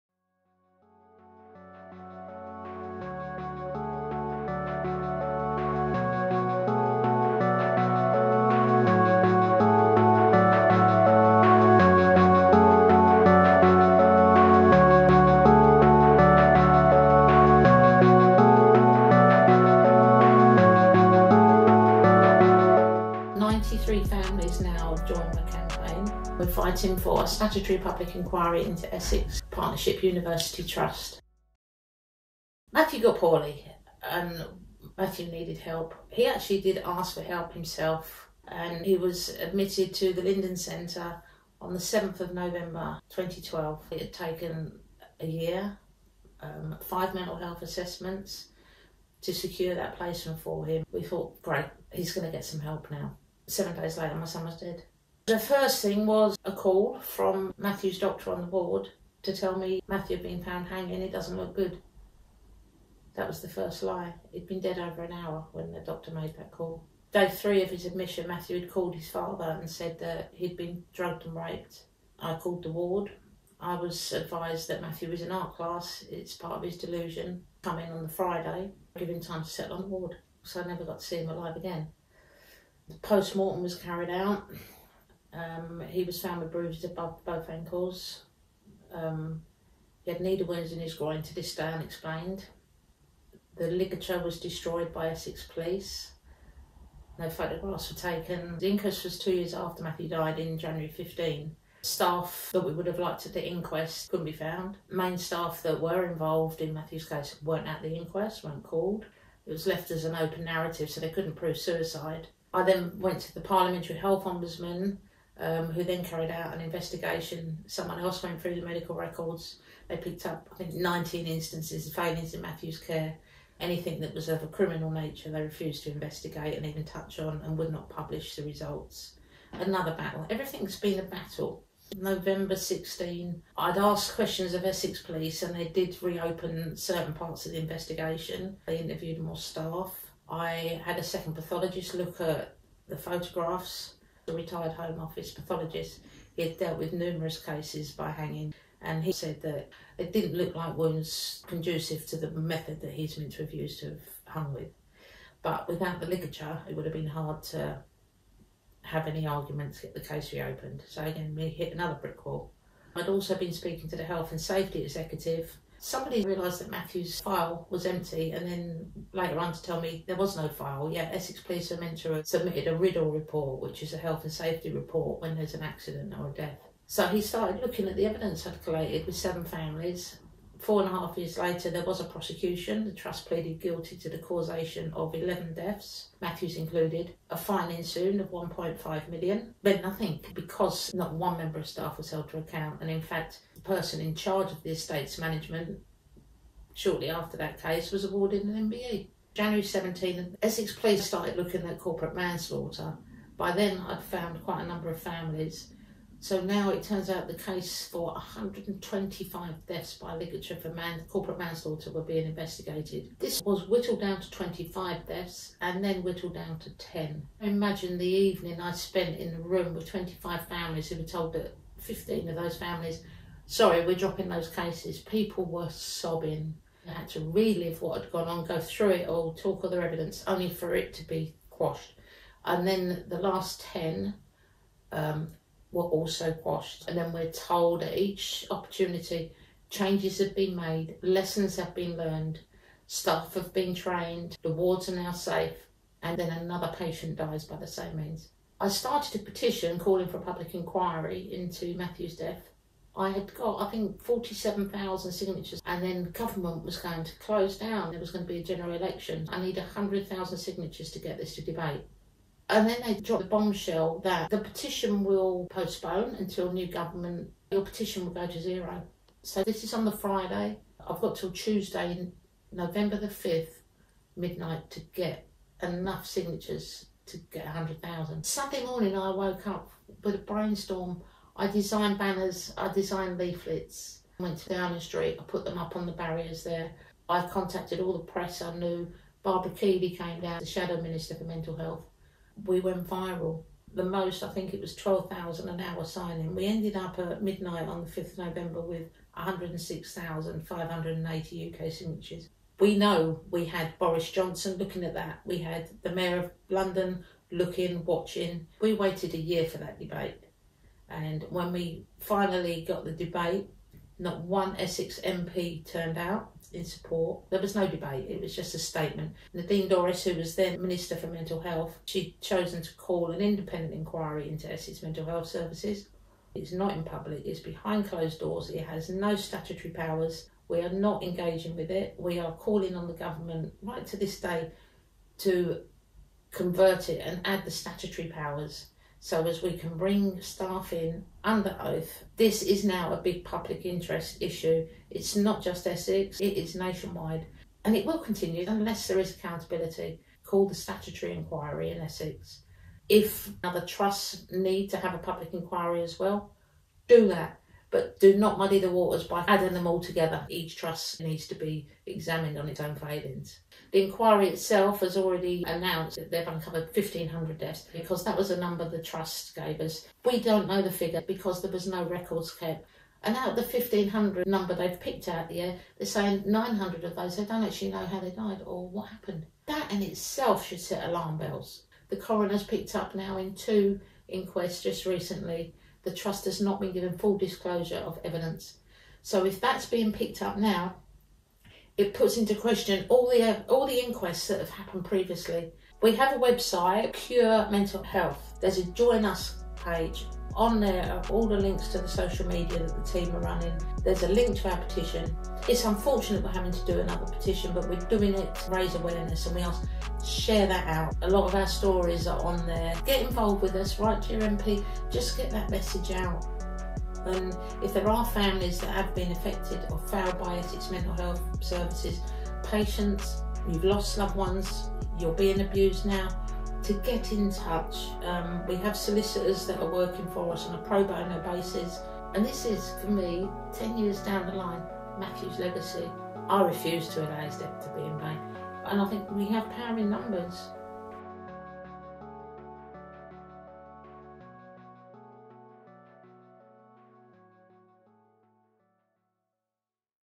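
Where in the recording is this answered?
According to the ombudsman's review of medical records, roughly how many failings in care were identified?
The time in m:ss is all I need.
2:00.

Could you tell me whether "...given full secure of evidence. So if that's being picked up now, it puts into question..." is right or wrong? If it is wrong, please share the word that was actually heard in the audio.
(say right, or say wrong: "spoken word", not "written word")
wrong: "disclosure", not "secure".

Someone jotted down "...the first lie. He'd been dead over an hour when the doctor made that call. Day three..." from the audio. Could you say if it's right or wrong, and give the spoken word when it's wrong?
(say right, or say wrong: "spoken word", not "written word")
right.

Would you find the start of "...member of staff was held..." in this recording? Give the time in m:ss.
3:11.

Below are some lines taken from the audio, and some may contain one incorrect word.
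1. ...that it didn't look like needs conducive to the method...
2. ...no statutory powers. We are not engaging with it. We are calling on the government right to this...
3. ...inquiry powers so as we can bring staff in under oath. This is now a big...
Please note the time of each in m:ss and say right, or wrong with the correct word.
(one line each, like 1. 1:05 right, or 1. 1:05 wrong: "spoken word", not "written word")
1. 2:29 wrong: "wounds", not "needs"
2. 5:28 right
3. 5:37 wrong: "statutory", not "inquiry".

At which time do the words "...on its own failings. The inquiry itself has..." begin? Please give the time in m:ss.
6:02.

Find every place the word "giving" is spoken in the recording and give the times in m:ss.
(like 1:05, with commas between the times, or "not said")
1:18.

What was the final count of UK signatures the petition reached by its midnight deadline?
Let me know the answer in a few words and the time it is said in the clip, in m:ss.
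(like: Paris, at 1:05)
106,580, at 4:59.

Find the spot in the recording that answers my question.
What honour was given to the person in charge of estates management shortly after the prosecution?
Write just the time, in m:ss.
3:18.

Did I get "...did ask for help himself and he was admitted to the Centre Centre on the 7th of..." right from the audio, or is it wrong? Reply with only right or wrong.
wrong.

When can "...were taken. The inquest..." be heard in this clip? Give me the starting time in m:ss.
1:37.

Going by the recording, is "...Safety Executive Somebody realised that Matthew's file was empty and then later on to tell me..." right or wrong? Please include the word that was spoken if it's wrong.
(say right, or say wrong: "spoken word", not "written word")
right.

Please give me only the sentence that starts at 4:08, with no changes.
I started a petition calling for a public inquiry into Matthew's death.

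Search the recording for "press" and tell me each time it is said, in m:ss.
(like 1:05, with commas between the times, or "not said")
4:48.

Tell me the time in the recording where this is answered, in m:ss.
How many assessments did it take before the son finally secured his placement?
0:46.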